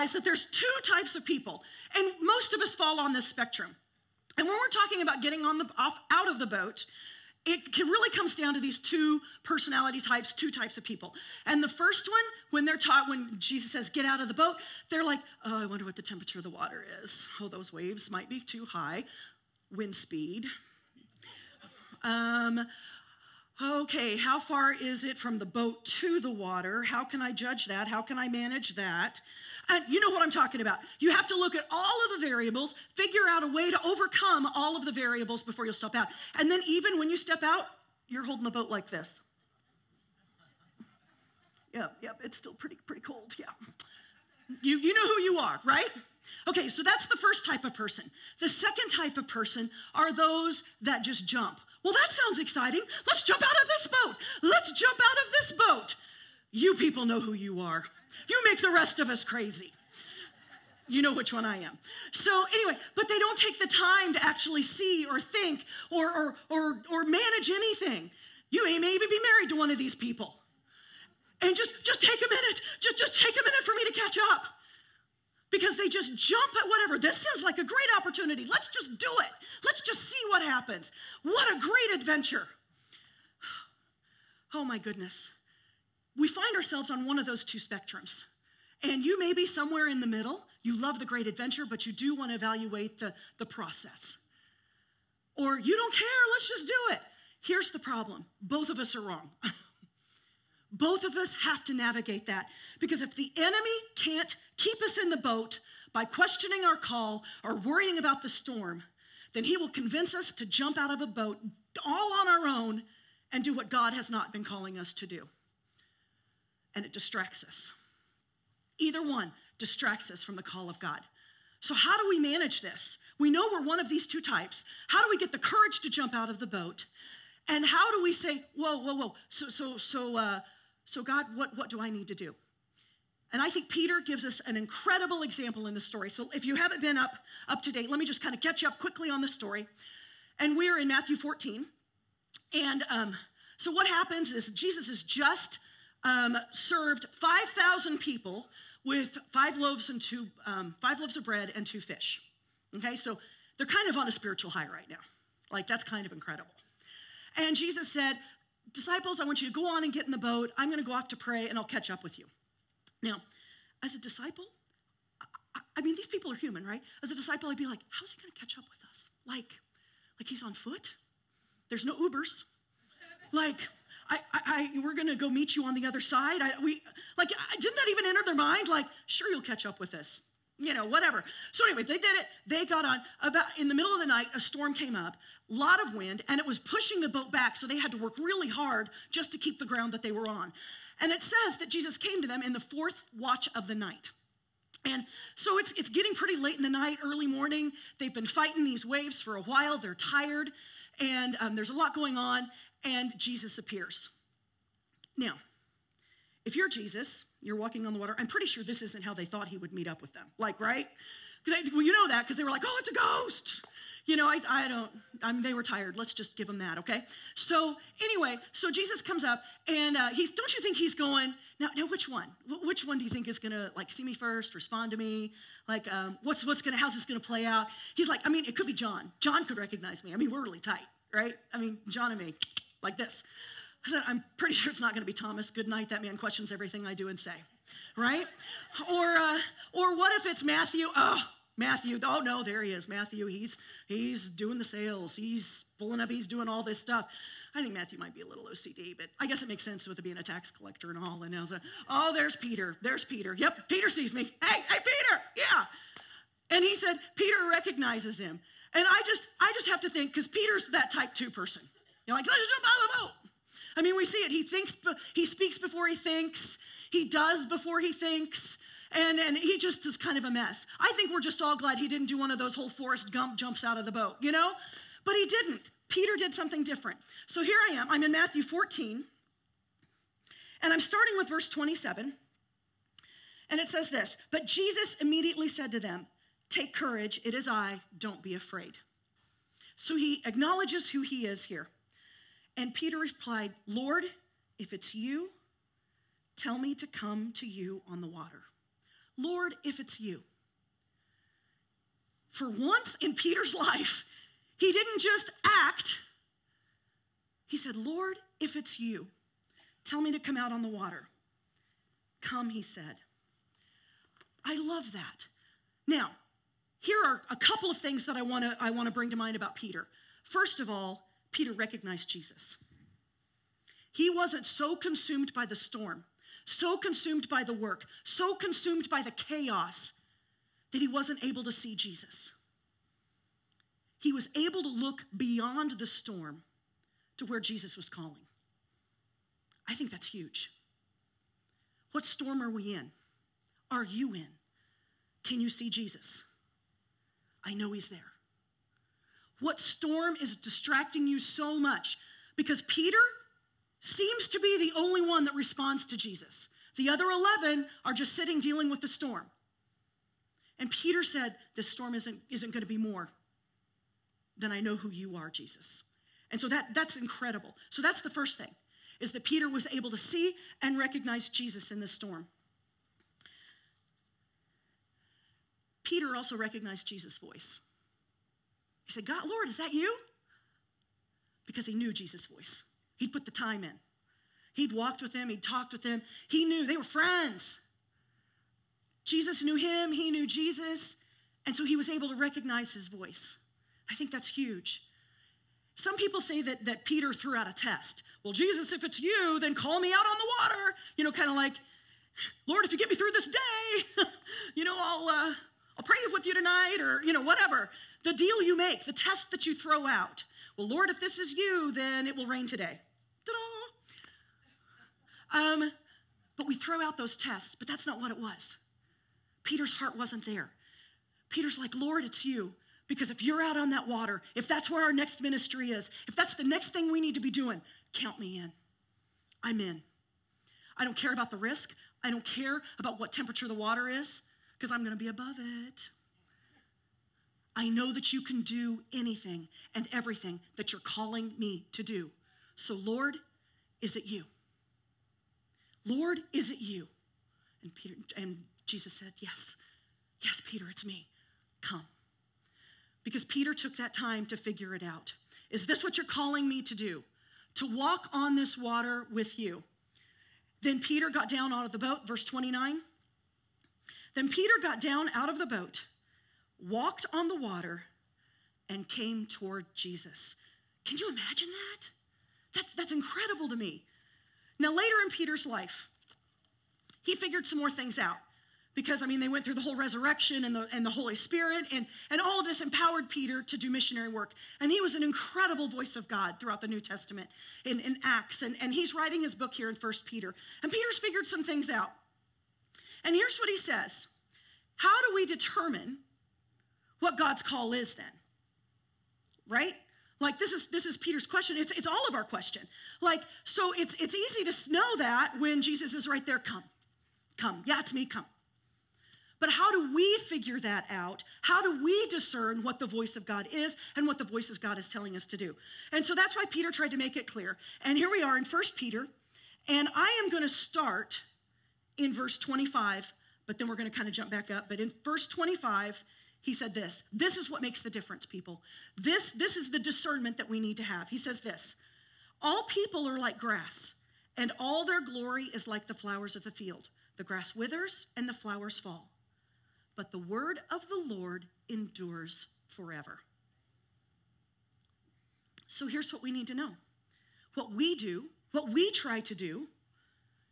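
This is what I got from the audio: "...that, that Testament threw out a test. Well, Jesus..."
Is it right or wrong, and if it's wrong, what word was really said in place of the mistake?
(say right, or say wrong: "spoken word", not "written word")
wrong: "Peter", not "Testament".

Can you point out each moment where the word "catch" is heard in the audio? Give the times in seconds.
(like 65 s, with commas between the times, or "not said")
73 s, 138 s, 161 s, 168 s, 179 s.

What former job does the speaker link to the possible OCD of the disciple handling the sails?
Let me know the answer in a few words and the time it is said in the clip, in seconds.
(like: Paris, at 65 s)
Tax collector, at 250 s.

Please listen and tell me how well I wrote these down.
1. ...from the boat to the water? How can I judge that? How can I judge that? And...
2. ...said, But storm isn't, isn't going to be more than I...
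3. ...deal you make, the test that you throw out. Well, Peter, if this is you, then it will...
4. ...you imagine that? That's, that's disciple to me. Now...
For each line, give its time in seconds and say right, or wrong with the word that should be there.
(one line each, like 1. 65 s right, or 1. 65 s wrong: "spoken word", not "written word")
1. 25 s wrong: "manage", not "judge"
2. 361 s wrong: "This", not "But"
3. 408 s wrong: "Lord", not "Peter"
4. 470 s wrong: "incredible", not "disciple".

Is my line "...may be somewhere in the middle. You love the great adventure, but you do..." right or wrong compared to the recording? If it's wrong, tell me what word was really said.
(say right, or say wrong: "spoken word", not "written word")
right.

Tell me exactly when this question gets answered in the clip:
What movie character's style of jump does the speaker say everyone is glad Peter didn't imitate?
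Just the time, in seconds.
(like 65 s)
272 s.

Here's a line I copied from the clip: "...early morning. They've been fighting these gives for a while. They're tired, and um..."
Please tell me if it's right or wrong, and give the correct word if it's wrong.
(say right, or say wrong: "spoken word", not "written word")
wrong: "waves", not "gives".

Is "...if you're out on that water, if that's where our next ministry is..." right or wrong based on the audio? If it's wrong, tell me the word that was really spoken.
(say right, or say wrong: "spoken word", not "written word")
right.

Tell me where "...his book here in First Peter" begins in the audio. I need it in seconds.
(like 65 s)
489 s.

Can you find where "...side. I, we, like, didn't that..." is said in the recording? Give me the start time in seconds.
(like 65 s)
176 s.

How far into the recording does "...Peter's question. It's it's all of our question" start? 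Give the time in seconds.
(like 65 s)
500 s.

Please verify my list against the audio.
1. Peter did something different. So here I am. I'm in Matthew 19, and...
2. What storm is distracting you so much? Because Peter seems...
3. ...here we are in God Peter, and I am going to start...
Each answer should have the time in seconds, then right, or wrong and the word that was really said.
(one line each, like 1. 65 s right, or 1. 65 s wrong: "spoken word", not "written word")
1. 275 s wrong: "14", not "19"
2. 349 s right
3. 517 s wrong: "First", not "God".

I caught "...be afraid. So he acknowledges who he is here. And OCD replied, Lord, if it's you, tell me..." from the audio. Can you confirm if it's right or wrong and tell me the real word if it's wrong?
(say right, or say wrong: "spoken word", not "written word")
wrong: "Peter", not "OCD".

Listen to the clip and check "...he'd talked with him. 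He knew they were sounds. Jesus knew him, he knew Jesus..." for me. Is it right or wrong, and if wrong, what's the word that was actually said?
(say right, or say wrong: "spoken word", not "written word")
wrong: "friends", not "sounds".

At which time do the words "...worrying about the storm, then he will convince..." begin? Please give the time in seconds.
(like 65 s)
107 s.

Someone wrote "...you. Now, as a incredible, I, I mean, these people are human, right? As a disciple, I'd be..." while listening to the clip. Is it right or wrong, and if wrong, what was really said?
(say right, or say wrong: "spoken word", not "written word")
wrong: "disciple", not "incredible".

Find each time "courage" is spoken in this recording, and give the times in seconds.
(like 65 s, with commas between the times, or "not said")
125 s, 286 s.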